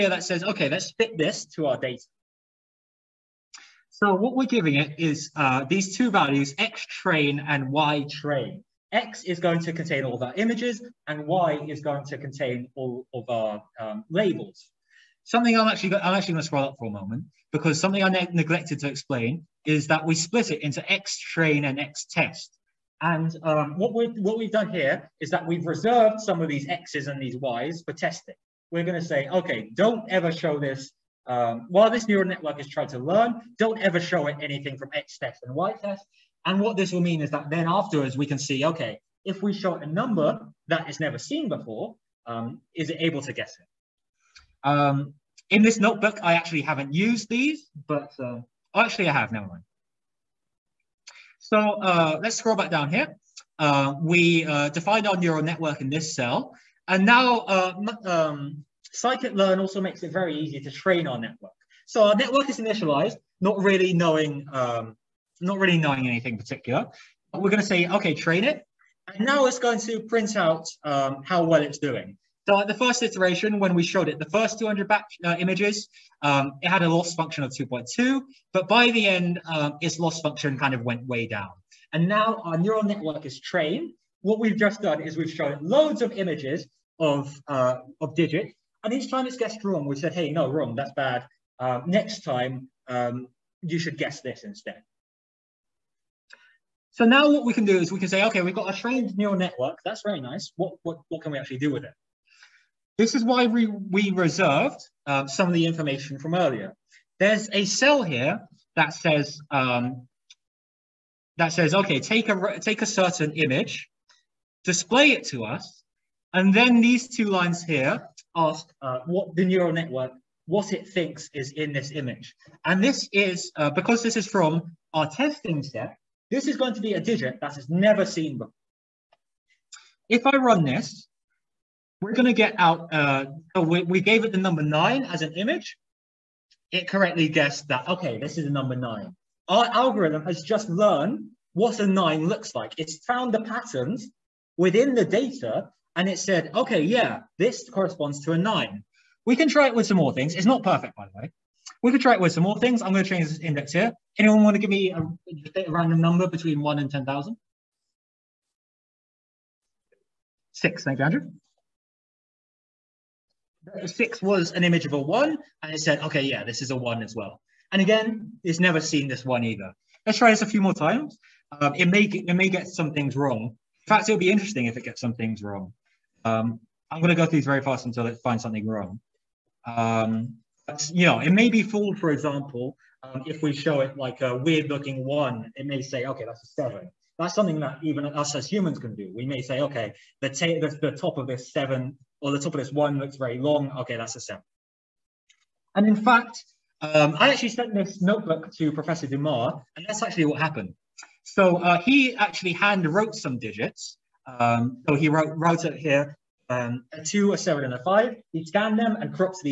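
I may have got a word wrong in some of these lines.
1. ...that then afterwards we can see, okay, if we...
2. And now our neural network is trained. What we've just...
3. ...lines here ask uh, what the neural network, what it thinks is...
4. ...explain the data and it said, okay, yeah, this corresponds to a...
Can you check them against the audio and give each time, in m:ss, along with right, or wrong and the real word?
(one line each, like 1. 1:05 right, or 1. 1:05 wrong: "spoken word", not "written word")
1. 0:37 right
2. 1:21 right
3. 1:57 right
4. 2:24 wrong: "within", not "explain".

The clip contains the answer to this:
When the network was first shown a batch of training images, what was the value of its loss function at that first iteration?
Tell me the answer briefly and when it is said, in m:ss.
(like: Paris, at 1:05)
2.2, at 1:17.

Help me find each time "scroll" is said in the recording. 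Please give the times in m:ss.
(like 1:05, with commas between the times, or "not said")
0:16, 0:52.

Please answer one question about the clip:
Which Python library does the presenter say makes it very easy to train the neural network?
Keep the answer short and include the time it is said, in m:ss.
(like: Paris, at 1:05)
Scikit-learn, at 0:58.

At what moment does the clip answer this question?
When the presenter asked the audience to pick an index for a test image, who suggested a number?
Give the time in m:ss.
2:41.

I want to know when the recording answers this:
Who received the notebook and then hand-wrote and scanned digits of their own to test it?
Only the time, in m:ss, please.
3:18.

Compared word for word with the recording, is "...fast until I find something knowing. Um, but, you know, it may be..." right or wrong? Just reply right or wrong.
wrong.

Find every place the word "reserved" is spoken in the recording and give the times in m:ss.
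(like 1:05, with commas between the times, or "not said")
0:25, 1:44.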